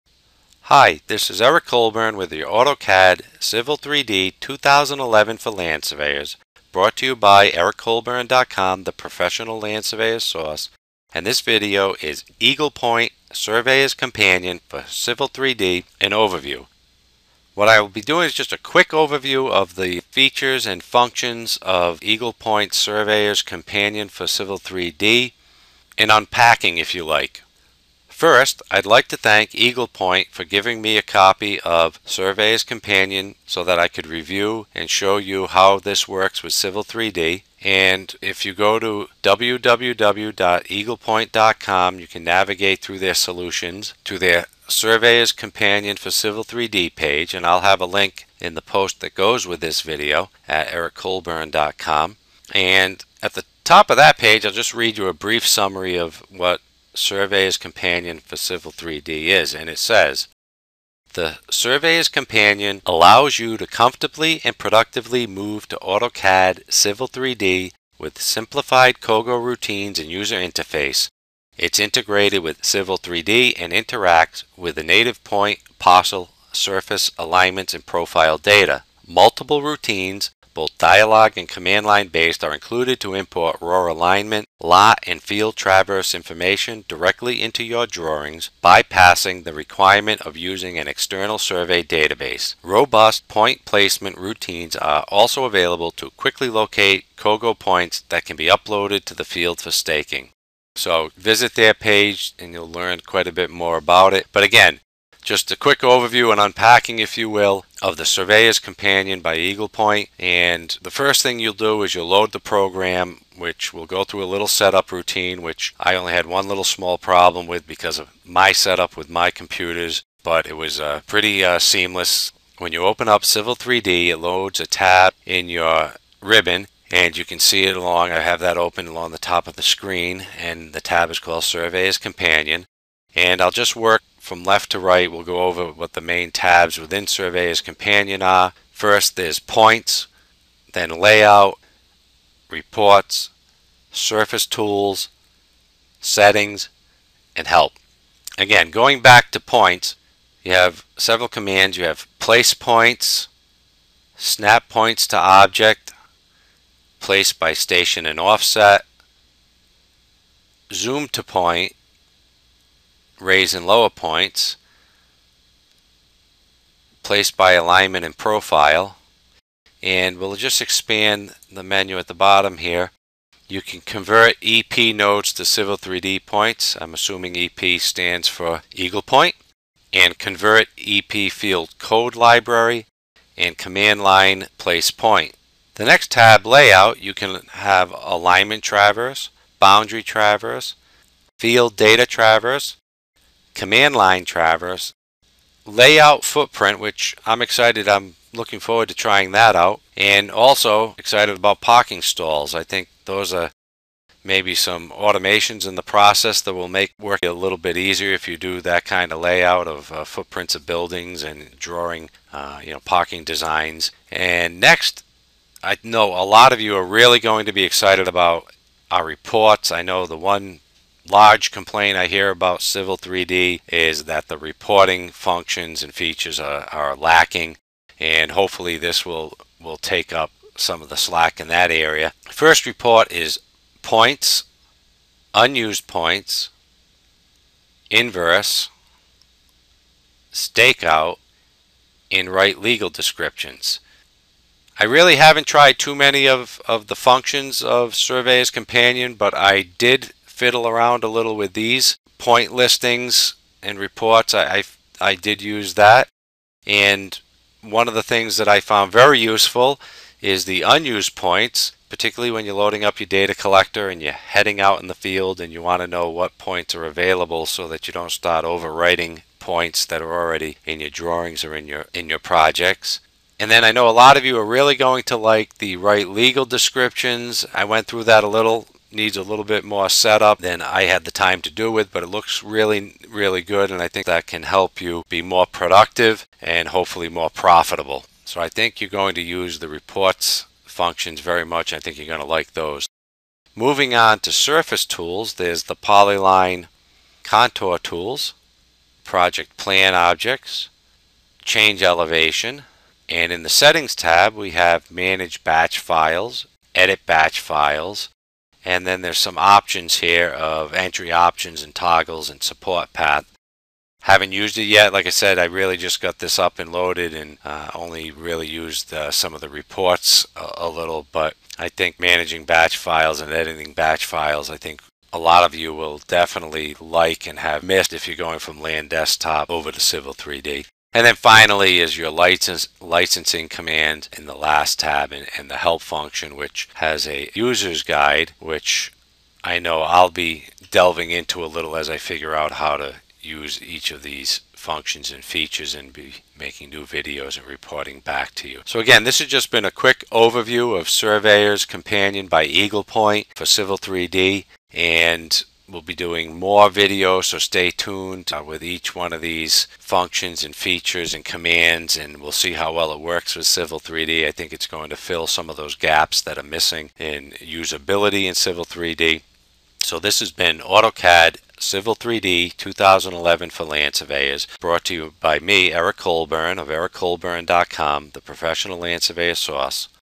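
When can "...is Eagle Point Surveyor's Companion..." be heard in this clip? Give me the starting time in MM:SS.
00:12.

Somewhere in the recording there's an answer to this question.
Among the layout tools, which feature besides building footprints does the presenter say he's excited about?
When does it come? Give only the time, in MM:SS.
03:21.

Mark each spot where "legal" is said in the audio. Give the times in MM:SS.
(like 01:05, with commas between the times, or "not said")
04:02, 04:36.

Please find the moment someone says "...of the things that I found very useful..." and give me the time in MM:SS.
04:17.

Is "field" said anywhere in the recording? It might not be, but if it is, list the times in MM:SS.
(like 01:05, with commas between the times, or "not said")
01:25, 01:39, 03:01, 03:11, 04:24.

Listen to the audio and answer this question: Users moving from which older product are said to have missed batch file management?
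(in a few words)
Land Desktop.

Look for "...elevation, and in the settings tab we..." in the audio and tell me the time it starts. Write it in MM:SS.
05:01.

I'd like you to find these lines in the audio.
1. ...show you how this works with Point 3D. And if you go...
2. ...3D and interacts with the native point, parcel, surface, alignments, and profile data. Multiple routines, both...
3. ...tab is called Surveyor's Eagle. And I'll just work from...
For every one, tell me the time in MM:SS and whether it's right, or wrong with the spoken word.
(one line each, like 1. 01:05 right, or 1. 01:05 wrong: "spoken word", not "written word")
1. 00:34 wrong: "Civil", not "Point"
2. 01:12 right
3. 02:10 wrong: "Companion", not "Eagle".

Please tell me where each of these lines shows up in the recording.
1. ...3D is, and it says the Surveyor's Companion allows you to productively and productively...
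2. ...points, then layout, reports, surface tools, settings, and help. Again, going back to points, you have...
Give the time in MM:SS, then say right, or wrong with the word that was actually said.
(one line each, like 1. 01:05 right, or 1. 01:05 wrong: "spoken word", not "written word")
1. 00:58 wrong: "comfortably", not "productively"
2. 02:19 right.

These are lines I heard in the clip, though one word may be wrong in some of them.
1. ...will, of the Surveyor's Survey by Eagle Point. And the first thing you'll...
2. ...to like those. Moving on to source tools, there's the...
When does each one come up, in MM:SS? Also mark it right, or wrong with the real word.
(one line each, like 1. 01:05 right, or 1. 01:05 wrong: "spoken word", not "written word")
1. 01:47 wrong: "Companion", not "Survey"
2. 04:52 wrong: "surface", not "source".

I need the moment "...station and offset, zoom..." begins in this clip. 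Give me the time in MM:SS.
02:37.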